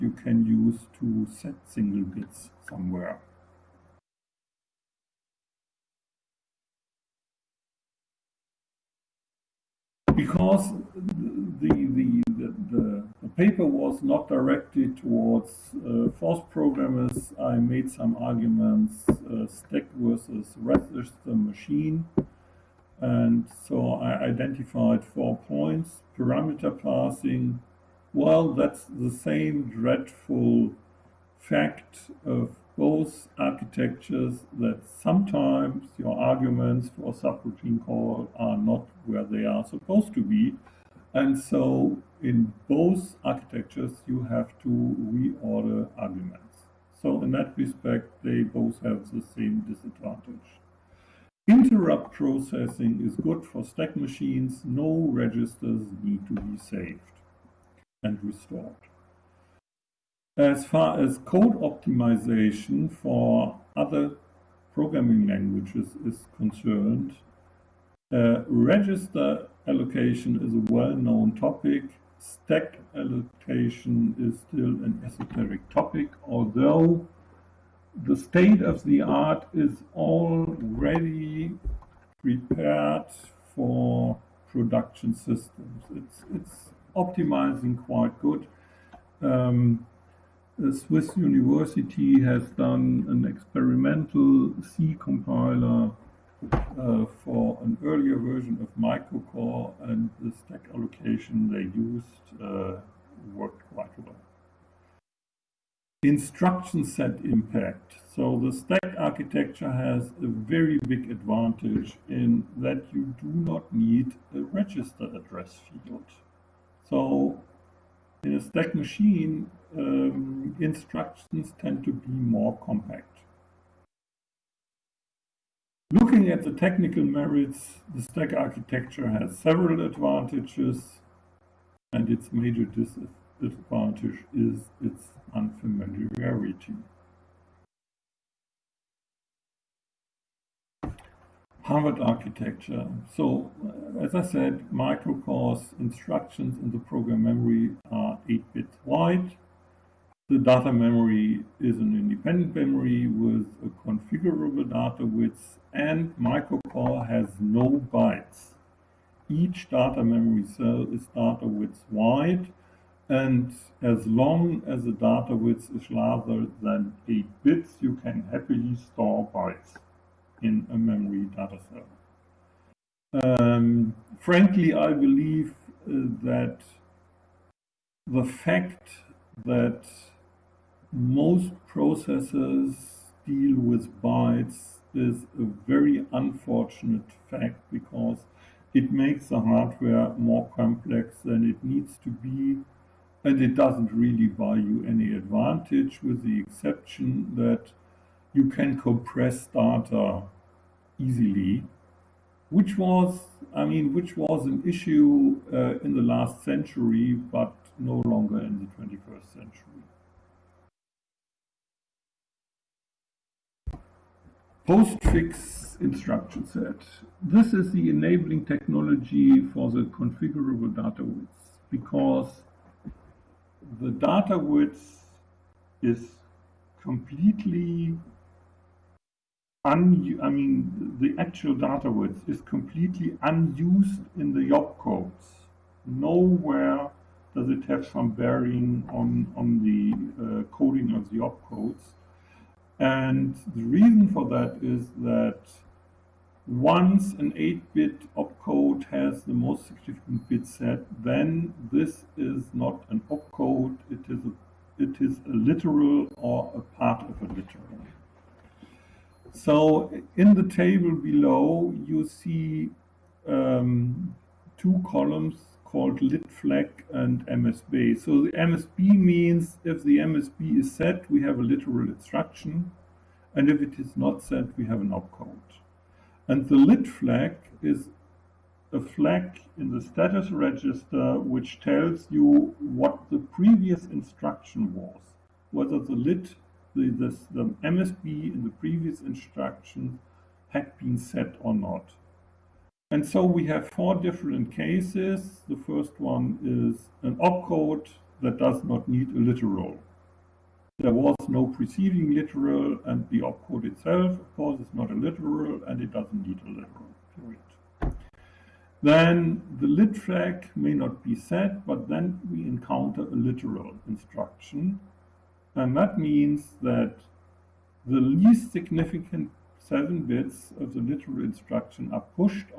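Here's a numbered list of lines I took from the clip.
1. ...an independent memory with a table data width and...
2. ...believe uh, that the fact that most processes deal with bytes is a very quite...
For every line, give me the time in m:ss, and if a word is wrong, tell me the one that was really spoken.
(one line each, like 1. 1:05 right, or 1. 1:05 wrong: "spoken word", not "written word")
1. 2:31 wrong: "configurable", not "table"
2. 2:54 wrong: "unfortunate", not "quite".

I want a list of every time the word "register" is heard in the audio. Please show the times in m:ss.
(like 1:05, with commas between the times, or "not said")
0:20, 0:55, 1:08, 1:54, 4:40.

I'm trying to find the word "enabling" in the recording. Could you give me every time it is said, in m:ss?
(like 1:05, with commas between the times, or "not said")
3:37.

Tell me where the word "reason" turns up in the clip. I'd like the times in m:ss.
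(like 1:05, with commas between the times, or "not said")
4:03.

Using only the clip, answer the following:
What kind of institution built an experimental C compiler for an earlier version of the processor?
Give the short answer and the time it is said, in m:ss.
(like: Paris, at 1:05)
Swiss University, at 1:30.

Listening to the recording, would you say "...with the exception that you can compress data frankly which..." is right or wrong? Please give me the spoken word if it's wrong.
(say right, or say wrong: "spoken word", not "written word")
wrong: "easily", not "frankly".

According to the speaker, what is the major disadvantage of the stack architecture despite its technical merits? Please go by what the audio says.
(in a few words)
unfamiliarity.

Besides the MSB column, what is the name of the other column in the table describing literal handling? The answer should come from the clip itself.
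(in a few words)
litflag.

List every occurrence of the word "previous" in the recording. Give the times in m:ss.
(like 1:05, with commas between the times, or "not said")
4:43, 4:48.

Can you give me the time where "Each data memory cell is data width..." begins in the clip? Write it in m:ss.
2:39.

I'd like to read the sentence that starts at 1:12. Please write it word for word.
Stack allocation is still an esoteric topic, although the state of the art is already prepared for production systems.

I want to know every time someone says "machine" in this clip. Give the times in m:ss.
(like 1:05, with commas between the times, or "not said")
0:21, 0:53, 1:58.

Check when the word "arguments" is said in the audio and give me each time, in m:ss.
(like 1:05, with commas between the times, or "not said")
0:18, 0:36, 0:45.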